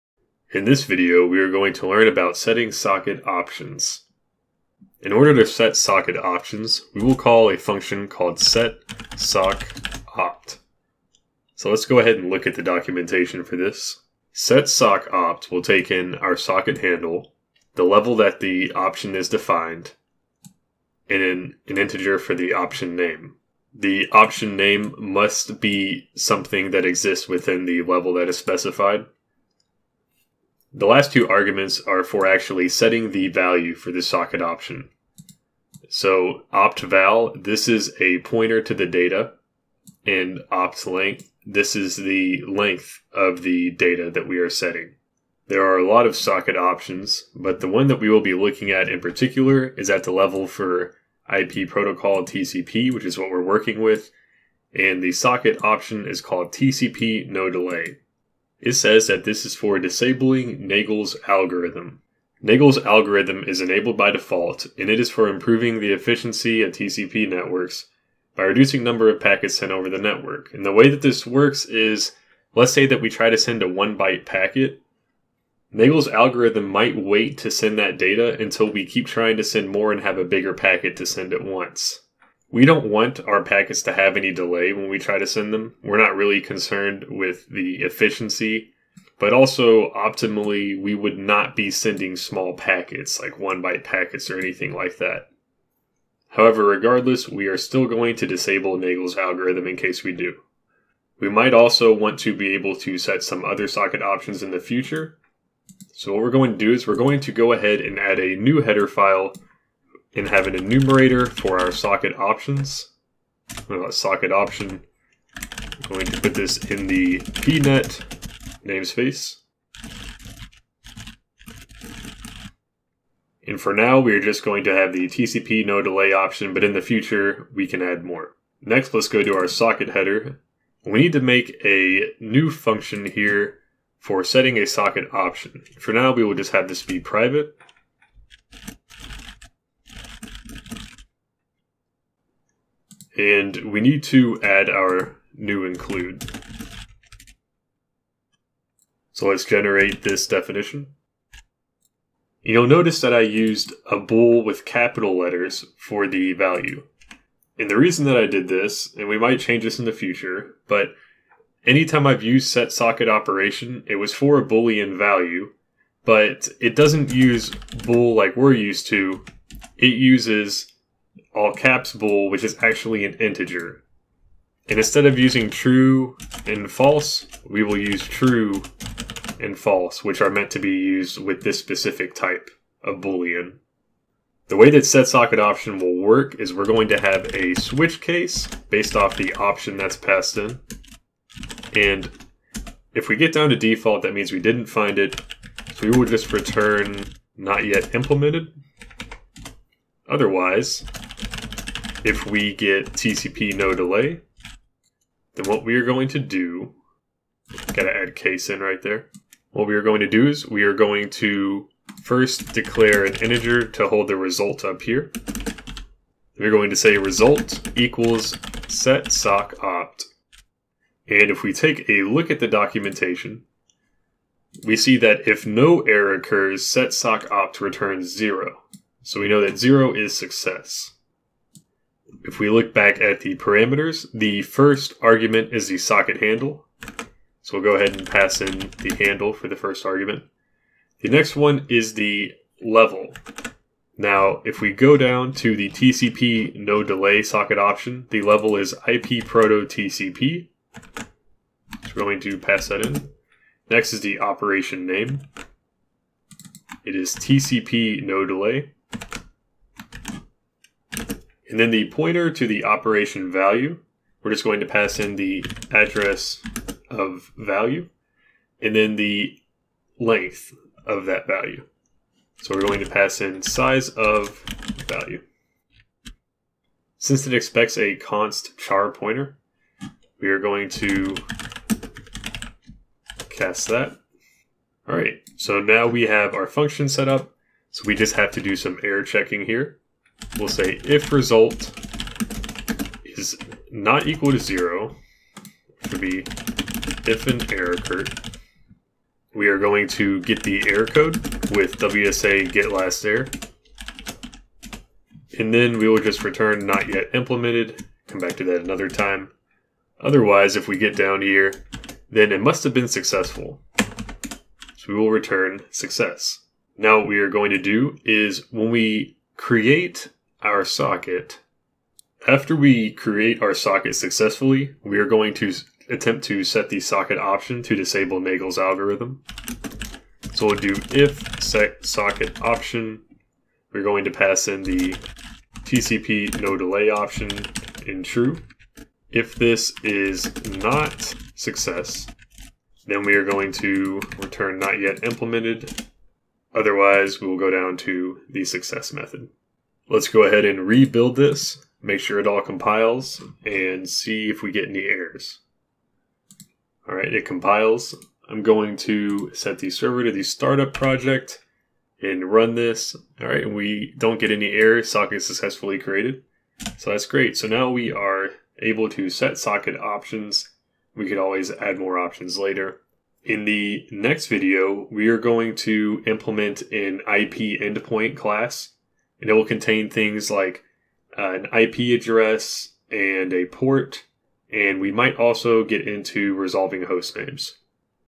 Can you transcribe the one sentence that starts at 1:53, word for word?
socket option, I'm going to put this in the pnet namespace.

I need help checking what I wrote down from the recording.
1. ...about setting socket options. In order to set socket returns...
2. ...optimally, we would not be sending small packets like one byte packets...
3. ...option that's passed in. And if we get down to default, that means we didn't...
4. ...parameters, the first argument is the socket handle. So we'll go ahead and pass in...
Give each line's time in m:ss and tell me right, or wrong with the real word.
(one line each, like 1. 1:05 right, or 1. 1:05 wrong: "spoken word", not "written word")
1. 0:02 wrong: "options", not "returns"
2. 1:29 right
3. 3:09 right
4. 3:53 right.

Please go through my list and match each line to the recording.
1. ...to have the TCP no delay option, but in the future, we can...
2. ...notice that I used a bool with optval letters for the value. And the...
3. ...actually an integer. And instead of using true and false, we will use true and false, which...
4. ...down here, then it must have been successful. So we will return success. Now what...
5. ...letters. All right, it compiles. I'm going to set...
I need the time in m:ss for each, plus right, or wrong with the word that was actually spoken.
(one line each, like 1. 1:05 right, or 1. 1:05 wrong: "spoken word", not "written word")
1. 2:04 right
2. 2:32 wrong: "capital", not "optval"
3. 2:52 right
4. 5:10 right
5. 5:54 wrong: "errors", not "letters".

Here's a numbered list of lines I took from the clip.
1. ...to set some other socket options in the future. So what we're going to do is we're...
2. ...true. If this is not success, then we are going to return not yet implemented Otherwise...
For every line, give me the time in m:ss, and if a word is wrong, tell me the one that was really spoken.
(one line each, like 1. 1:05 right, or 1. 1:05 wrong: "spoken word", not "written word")
1. 1:42 right
2. 5:38 right.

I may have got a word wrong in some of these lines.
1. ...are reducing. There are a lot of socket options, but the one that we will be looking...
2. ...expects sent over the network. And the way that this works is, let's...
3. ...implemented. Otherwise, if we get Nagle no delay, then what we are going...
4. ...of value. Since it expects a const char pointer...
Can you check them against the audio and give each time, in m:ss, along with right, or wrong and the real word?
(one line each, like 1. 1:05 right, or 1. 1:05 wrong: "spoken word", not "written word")
1. 0:44 wrong: "setting", not "reducing"
2. 1:09 wrong: "packets", not "expects"
3. 3:17 wrong: "TCP", not "Nagle"
4. 4:33 right.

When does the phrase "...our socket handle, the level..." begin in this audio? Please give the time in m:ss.
0:16.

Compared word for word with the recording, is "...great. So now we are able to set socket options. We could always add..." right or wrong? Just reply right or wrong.
right.